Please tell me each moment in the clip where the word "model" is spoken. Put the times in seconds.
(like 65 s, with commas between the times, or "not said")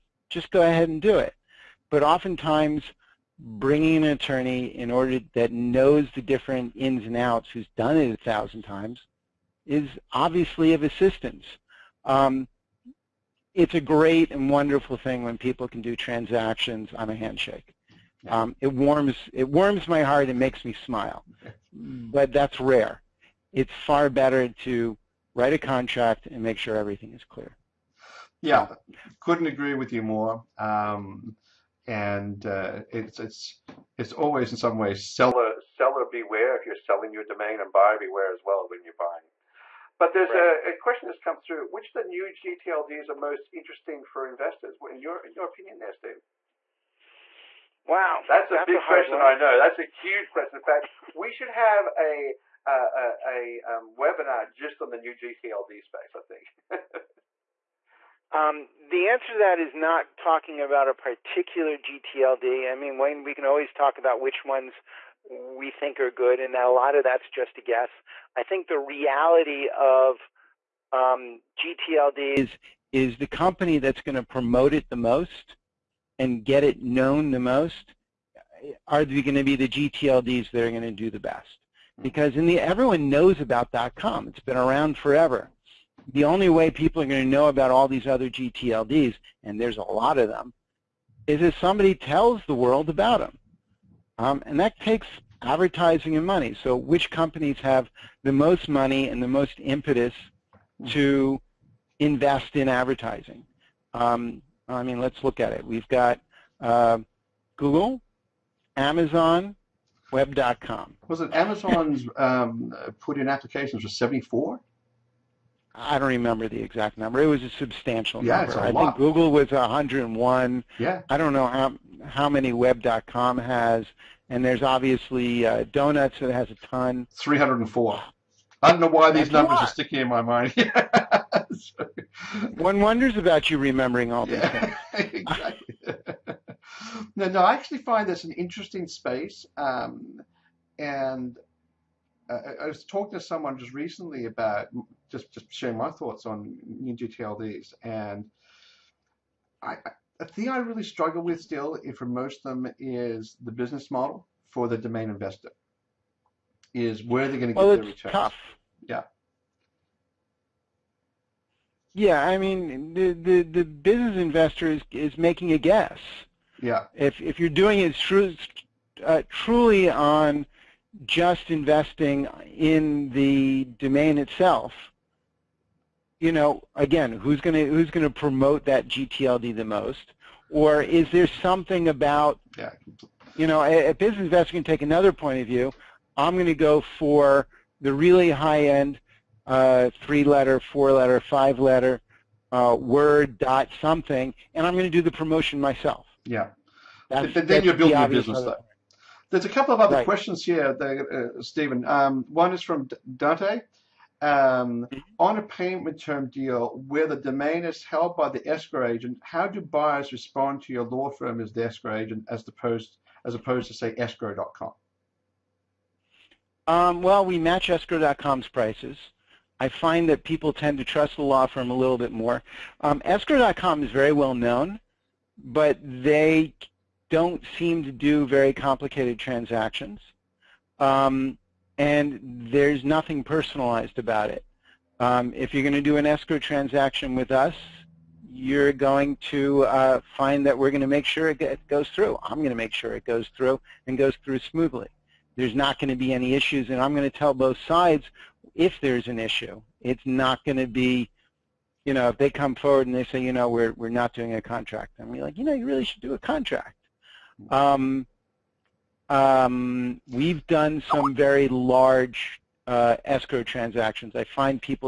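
153 s.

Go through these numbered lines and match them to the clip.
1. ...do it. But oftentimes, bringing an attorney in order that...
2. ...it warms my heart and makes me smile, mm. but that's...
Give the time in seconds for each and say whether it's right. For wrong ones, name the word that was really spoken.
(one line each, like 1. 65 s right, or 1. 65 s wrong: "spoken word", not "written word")
1. 1 s right
2. 19 s right.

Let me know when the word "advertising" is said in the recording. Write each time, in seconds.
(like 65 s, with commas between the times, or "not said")
95 s, 102 s.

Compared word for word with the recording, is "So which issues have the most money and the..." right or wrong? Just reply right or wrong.
wrong.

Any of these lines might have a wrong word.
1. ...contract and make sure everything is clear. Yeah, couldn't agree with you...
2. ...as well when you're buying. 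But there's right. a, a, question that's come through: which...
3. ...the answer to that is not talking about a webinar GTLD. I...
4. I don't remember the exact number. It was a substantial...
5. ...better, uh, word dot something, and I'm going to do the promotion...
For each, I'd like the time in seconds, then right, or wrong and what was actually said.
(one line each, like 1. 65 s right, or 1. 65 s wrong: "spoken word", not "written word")
1. 25 s right
2. 38 s right
3. 58 s wrong: "particular", not "webinar"
4. 115 s right
5. 191 s wrong: "letter", not "better".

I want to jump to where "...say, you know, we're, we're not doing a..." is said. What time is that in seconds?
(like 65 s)
253 s.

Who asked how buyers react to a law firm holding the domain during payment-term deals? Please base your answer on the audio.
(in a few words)
Dante.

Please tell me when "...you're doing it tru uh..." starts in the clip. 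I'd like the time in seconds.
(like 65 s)
167 s.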